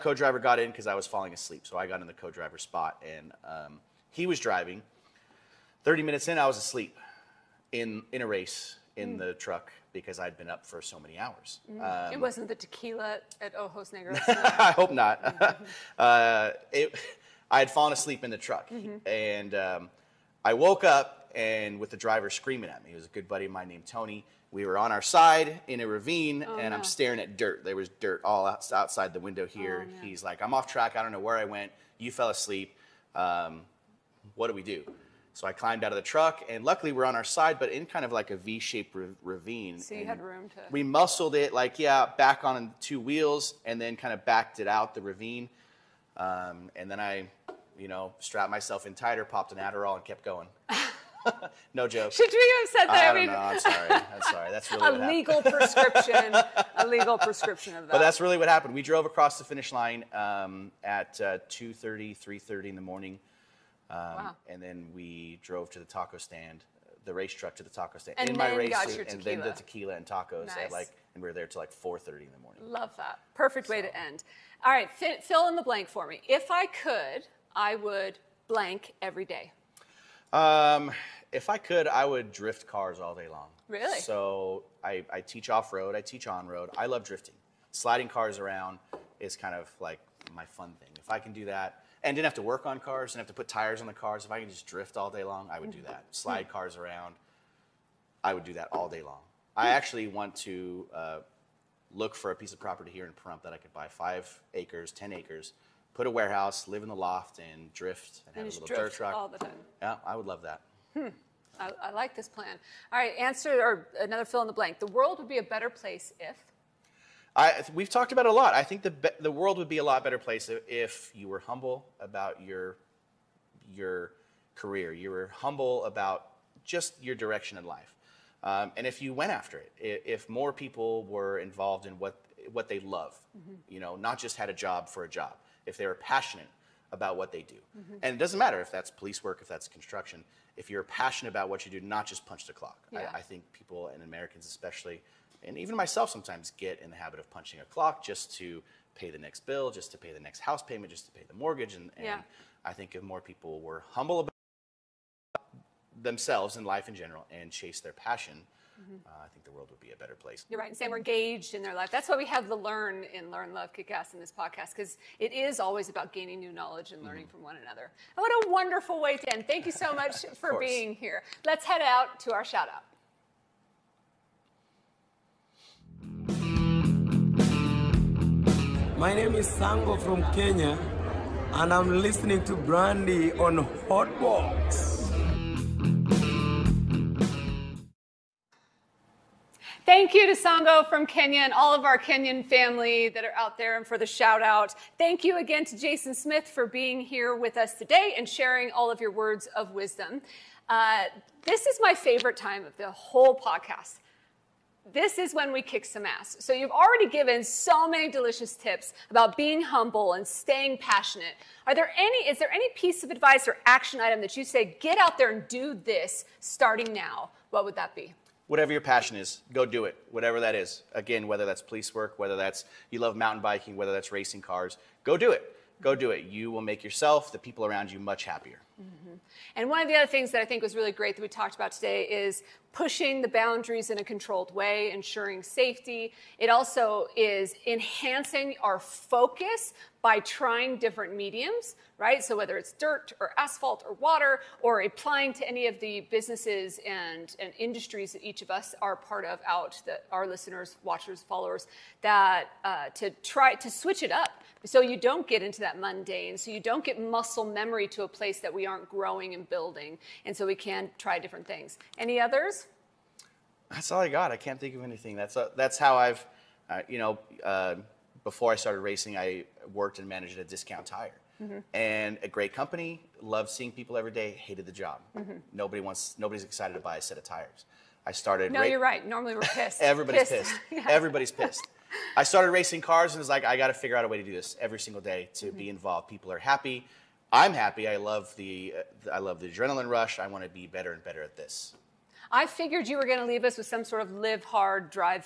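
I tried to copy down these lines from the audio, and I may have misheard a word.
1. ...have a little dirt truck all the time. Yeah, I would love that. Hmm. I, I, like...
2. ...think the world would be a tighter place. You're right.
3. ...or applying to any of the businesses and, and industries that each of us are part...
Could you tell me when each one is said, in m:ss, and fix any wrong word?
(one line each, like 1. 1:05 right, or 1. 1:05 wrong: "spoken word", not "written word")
1. 1:48 right
2. 2:39 wrong: "better", not "tighter"
3. 4:04 right.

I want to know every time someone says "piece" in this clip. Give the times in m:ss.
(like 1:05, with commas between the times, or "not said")
1:42, 3:32.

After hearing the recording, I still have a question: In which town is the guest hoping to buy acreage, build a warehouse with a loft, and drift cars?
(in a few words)
Pahrump.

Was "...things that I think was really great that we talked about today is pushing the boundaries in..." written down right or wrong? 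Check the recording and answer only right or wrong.
right.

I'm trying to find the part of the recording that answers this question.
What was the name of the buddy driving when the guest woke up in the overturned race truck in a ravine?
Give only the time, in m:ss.
0:23.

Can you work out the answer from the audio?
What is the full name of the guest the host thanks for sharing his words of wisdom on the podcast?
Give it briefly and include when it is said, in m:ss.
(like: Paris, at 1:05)
Jason Smith, at 3:15.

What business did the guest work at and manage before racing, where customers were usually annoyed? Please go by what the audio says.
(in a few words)
Discount Tire.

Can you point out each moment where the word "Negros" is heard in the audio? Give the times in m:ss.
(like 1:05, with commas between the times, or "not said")
0:13.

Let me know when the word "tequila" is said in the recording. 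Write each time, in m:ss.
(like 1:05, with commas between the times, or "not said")
0:12, 1:09.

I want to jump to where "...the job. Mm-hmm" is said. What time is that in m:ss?
4:34.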